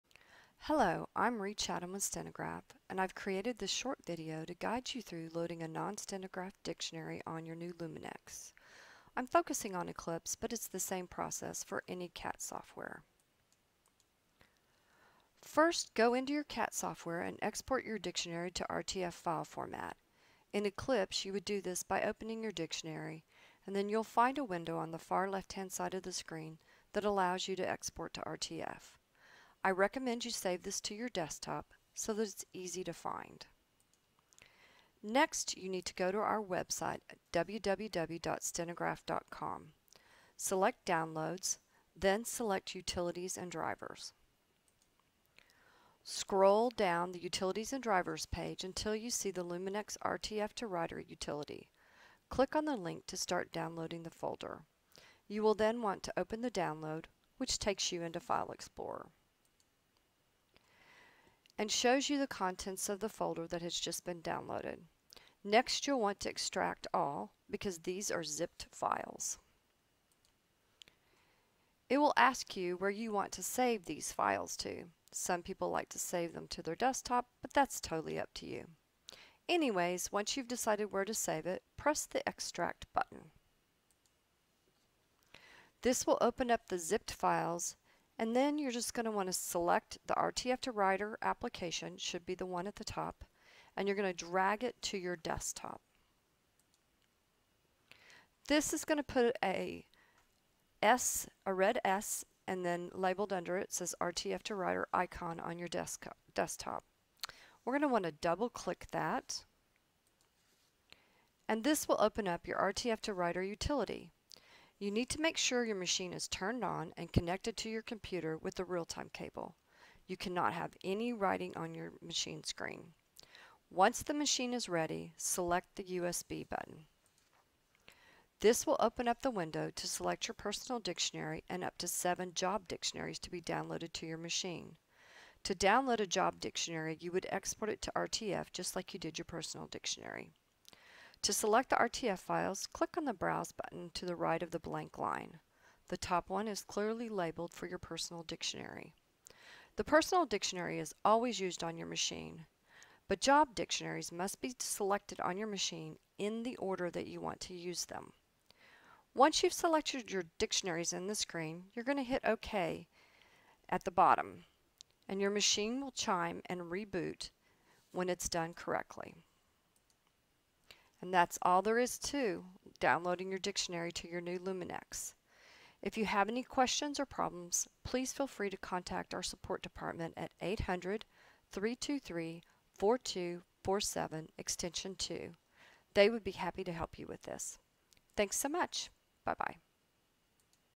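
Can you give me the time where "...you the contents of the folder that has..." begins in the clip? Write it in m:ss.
1:02.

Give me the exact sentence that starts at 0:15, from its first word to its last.
First, go into your CAT software and export your dictionary to RTF file format.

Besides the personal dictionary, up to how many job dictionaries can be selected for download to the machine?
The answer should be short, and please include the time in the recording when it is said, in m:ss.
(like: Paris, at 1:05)
7, at 2:11.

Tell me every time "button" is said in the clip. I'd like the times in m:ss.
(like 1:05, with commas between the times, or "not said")
1:22, 2:06, 2:23.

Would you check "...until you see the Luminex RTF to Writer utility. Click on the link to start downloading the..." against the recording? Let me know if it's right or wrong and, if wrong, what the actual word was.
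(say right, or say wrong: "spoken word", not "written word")
right.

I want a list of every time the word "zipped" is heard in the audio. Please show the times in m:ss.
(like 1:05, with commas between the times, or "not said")
1:08, 1:26.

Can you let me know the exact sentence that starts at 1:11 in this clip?
It will ask you where you want to save these files to.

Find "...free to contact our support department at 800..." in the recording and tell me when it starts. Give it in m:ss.
2:58.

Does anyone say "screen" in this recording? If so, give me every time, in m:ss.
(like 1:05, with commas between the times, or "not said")
0:26, 2:02, 2:41.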